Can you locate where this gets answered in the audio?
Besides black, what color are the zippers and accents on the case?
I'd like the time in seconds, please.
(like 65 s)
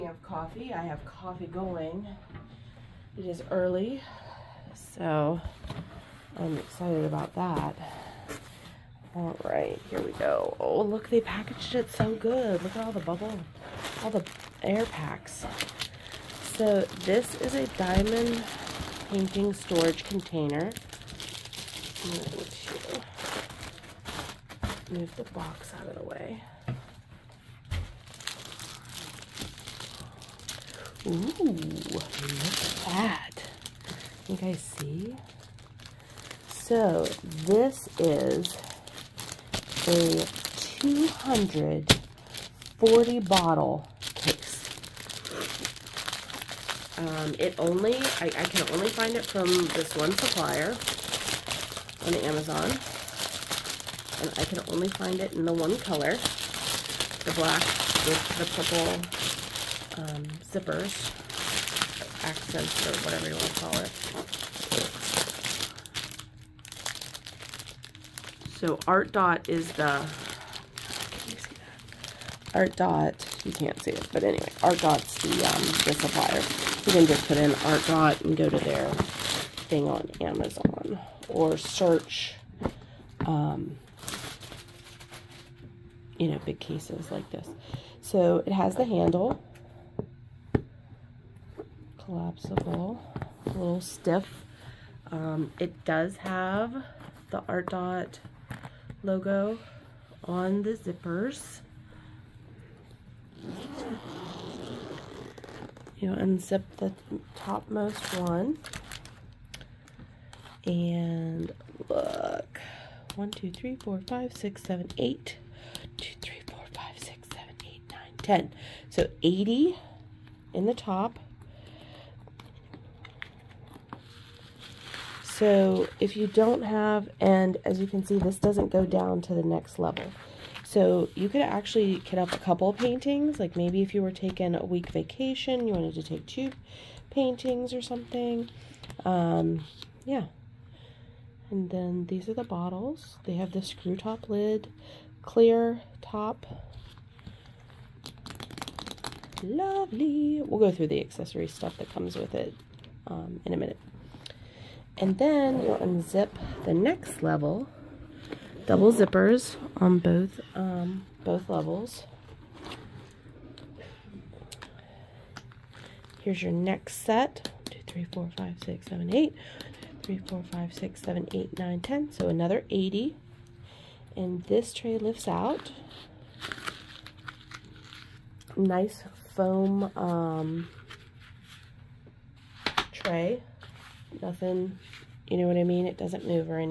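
58 s.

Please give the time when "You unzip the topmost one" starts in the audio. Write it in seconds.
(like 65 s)
106 s.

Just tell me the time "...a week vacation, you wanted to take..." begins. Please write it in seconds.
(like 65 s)
134 s.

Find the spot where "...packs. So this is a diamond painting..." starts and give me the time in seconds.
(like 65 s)
14 s.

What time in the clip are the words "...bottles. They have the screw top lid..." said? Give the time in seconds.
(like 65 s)
142 s.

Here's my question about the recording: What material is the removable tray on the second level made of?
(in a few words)
Foam.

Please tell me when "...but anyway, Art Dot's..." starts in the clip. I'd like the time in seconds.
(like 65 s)
74 s.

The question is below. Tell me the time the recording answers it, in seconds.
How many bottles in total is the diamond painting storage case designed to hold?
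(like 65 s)
40 s.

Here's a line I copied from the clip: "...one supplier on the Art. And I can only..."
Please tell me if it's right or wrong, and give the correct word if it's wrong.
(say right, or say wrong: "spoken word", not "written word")
wrong: "Amazon", not "Art".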